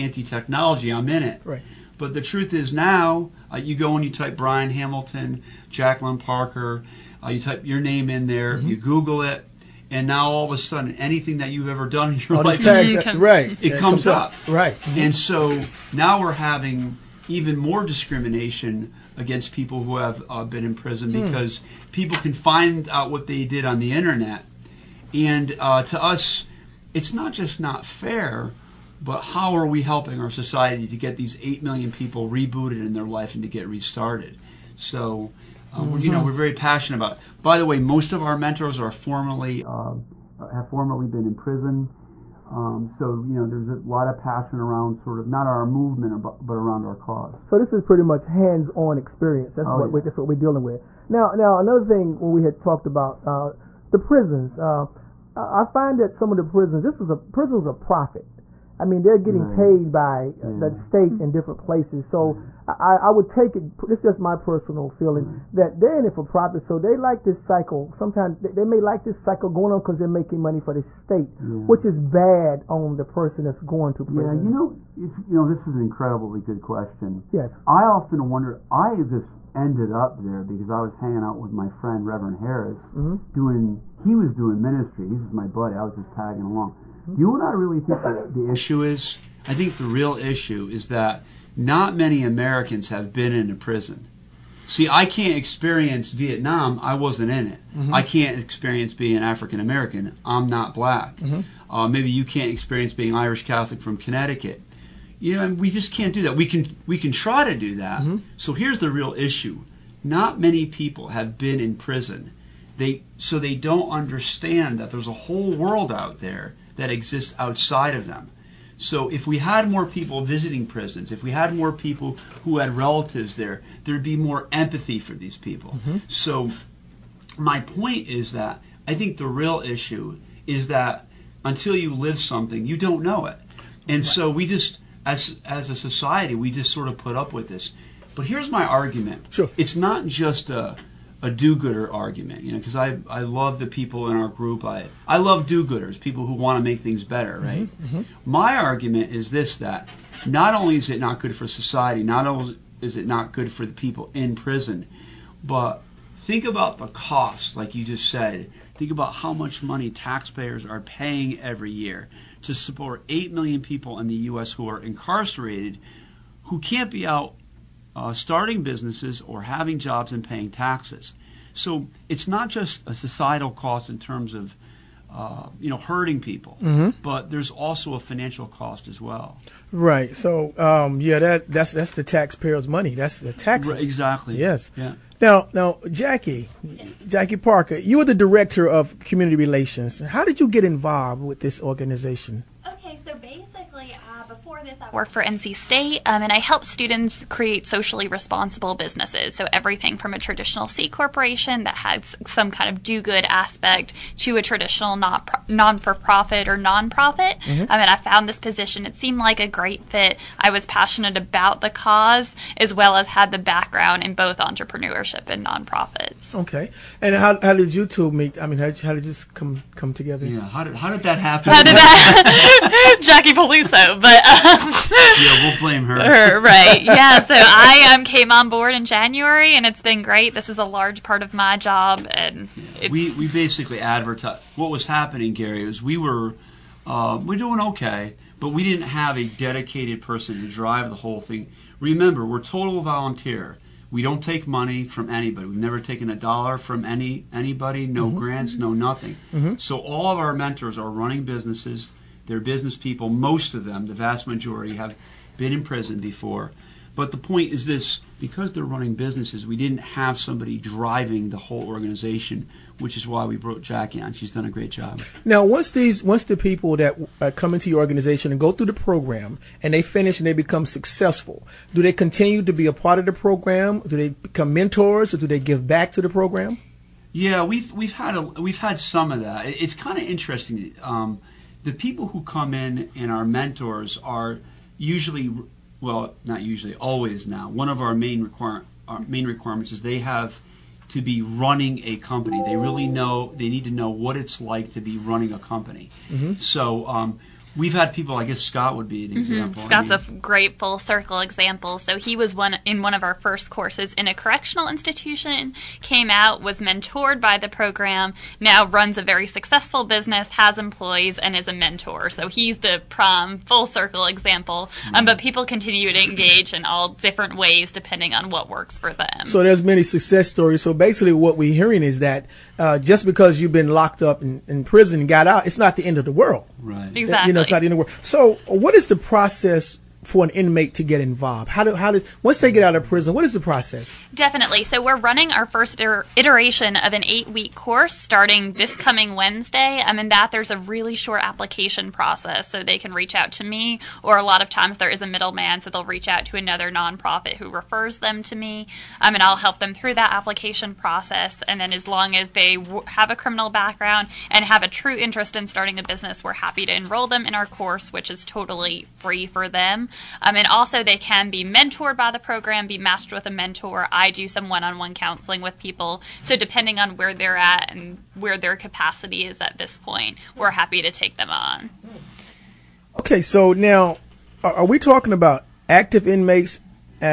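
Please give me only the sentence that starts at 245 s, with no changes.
We've never taken a dollar from any anybody.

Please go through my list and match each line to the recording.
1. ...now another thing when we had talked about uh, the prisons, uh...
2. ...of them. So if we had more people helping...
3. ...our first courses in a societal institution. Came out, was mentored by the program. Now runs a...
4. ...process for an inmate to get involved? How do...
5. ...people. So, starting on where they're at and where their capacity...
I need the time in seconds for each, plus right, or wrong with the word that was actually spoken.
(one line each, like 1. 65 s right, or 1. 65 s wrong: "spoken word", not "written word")
1. 51 s right
2. 117 s wrong: "visiting", not "helping"
3. 303 s wrong: "correctional", not "societal"
4. 328 s right
5. 365 s wrong: "depending", not "starting".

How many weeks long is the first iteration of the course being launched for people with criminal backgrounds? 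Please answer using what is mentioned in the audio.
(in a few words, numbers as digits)
8.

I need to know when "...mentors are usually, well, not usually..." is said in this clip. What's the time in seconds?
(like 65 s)
283 s.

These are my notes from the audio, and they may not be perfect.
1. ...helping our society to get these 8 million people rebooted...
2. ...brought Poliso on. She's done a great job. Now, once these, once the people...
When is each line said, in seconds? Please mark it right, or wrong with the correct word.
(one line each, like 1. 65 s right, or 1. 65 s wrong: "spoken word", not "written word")
1. 29 s right
2. 263 s wrong: "Jackie", not "Poliso".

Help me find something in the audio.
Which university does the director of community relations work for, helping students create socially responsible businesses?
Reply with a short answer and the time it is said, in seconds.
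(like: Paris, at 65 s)
NC State, at 195 s.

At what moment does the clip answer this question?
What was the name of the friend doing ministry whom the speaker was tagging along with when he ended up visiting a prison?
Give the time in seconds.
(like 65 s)
82 s.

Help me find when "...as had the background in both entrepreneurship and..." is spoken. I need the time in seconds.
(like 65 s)
212 s.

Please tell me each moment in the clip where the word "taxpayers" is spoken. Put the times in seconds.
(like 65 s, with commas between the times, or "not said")
159 s, 182 s.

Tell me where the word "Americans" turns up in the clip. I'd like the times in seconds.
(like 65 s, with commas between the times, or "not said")
92 s, 99 s.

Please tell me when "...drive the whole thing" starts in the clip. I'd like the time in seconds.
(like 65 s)
240 s.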